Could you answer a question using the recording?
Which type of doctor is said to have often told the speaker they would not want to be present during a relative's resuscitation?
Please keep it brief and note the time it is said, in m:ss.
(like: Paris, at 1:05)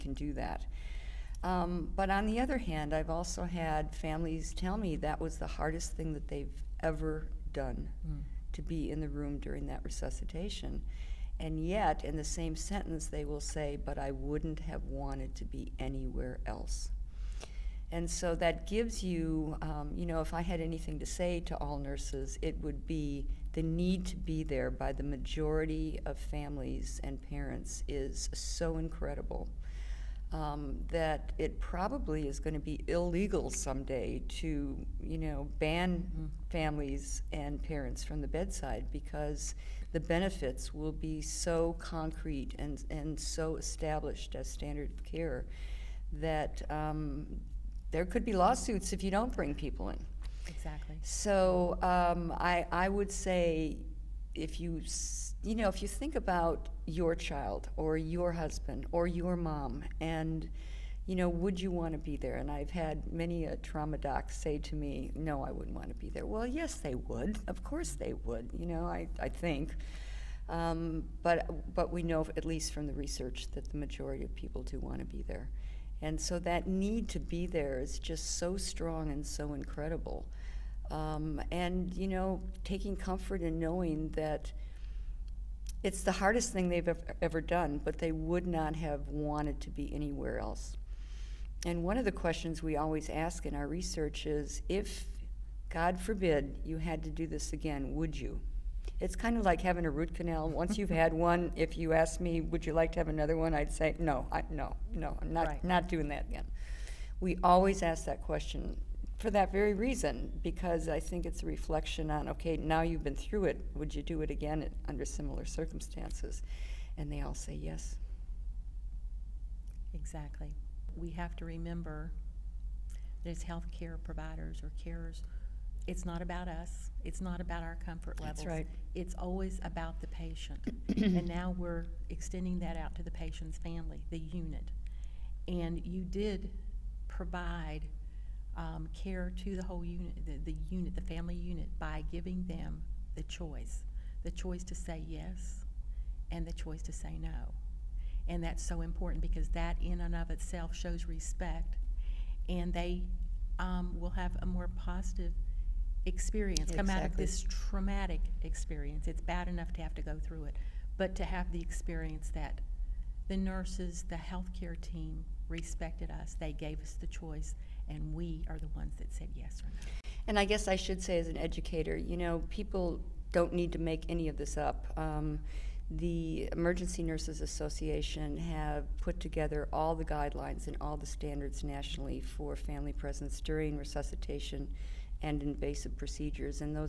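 Trauma doc, at 1:03.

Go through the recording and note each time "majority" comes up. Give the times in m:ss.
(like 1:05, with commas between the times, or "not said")
0:25, 1:13.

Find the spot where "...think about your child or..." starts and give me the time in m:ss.
0:55.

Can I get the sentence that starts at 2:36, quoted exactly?
come out of this traumatic experience.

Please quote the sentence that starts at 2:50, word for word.
And I guess I should say, as an educator, you know, people don't need to make any of this up.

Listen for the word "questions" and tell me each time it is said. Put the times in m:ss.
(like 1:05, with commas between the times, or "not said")
1:32, 1:48.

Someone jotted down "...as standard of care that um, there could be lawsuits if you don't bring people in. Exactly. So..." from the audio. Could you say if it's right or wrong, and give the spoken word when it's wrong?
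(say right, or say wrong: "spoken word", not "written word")
right.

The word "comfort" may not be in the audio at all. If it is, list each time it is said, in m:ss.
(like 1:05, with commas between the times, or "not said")
1:22, 2:07.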